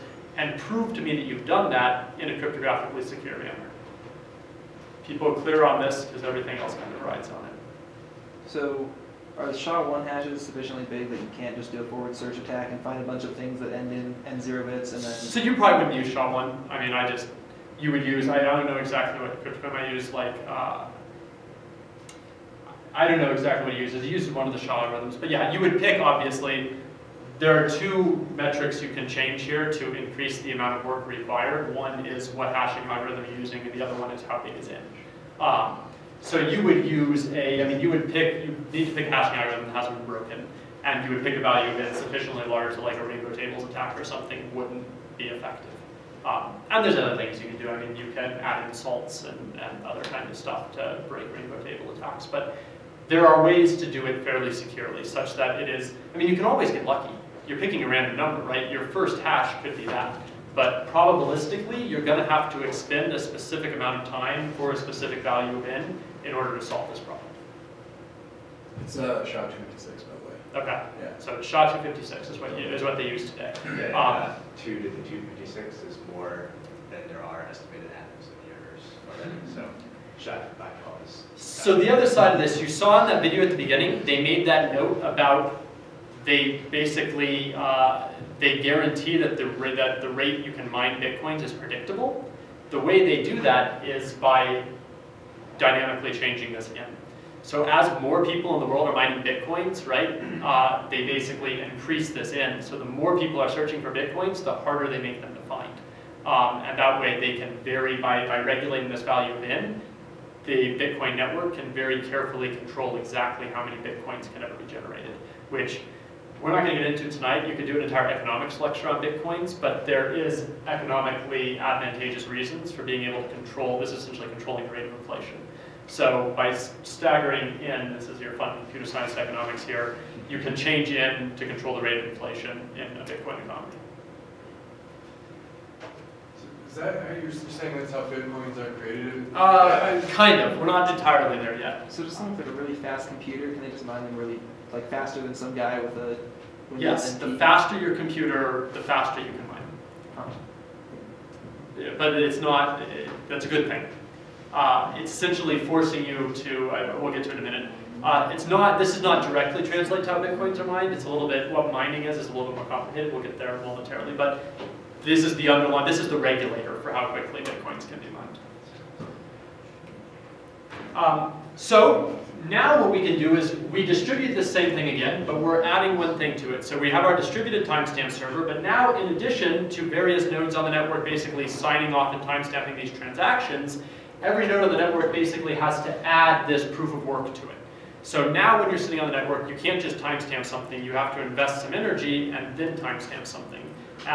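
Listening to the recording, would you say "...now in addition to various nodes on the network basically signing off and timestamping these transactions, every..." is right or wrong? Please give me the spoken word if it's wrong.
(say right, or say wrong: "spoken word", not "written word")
right.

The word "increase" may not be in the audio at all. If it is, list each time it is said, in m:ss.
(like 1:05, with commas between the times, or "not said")
0:29, 1:41.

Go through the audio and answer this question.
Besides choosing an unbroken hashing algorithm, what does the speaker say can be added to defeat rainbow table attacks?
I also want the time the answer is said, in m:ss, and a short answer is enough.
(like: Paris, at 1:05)
salts, at 0:48.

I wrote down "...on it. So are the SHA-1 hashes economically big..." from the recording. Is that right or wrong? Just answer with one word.
wrong.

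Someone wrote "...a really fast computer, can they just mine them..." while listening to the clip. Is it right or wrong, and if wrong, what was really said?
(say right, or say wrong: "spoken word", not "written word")
right.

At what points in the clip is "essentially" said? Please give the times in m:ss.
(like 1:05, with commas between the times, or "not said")
2:04, 2:35.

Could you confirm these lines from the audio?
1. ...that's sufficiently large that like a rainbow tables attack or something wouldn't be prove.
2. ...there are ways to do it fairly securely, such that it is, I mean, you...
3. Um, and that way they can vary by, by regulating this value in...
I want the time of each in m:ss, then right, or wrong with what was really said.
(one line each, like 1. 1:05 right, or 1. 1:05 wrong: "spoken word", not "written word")
1. 0:41 wrong: "effective", not "prove"
2. 0:53 right
3. 1:46 right.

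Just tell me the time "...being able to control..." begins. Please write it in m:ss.
2:02.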